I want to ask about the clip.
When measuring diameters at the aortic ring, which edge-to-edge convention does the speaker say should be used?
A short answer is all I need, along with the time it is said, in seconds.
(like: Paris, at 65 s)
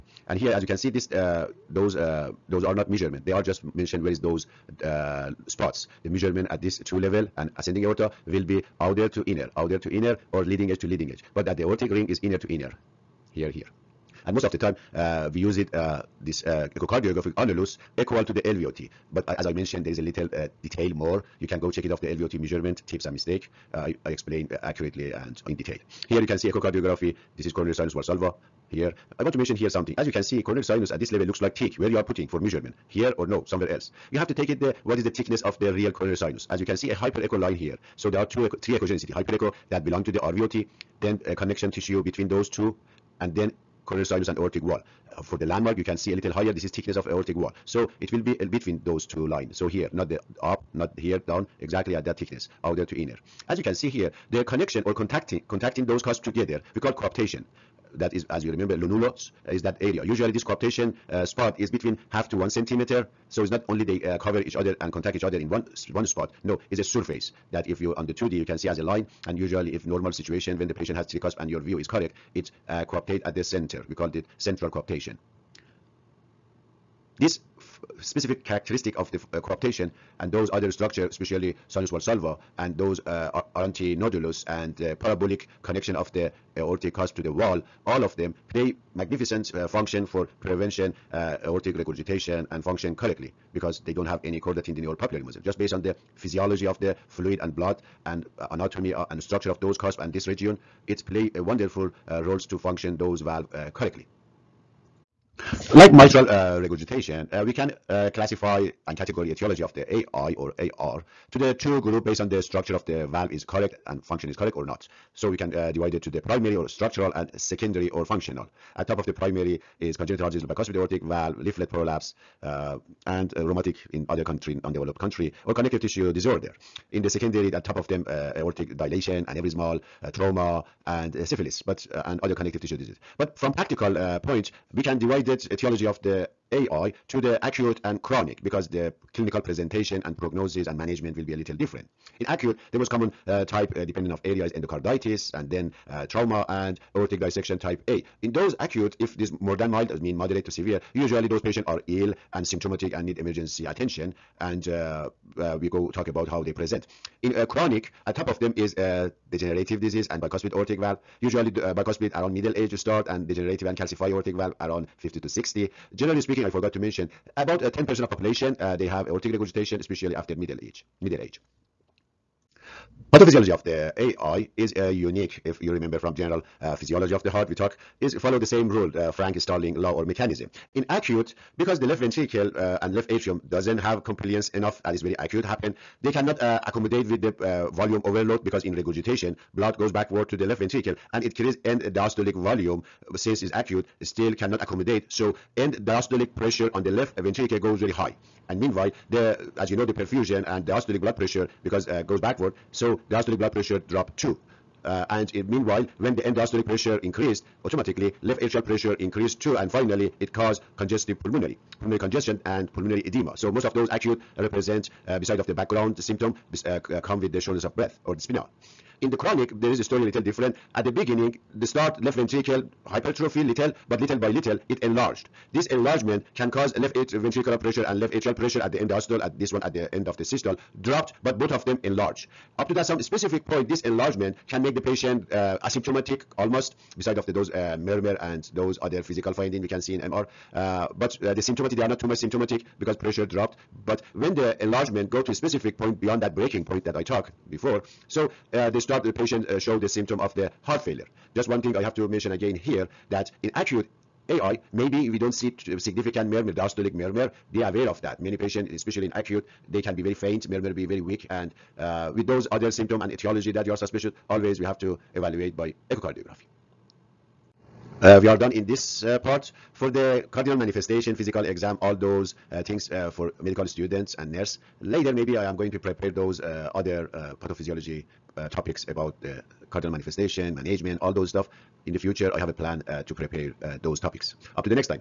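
Inner to inner, at 12 s.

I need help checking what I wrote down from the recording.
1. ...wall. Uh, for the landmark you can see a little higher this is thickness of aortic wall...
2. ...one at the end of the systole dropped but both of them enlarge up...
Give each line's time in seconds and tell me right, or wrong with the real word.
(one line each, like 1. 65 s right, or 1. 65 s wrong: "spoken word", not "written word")
1. 44 s right
2. 229 s right.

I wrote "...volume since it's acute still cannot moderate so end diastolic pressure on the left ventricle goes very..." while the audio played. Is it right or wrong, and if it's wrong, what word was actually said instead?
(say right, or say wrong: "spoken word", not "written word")
wrong: "accommodate", not "moderate".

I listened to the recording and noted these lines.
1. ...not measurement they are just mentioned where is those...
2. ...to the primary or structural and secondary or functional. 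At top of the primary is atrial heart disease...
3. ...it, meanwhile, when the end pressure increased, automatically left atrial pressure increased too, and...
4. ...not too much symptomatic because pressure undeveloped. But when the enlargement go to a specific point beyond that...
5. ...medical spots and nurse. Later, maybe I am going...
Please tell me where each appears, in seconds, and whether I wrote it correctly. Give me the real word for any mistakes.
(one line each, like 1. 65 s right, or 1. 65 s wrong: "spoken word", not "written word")
1. 2 s right
2. 116 s wrong: "congenital", not "atrial"
3. 205 s right
4. 241 s wrong: "dropped", not "undeveloped"
5. 273 s wrong: "students", not "spots".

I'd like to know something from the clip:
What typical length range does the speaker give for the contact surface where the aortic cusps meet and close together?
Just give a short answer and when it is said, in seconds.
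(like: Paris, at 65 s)
Half to one centimeter, at 62 s.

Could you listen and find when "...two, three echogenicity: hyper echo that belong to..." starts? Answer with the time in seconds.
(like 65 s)
38 s.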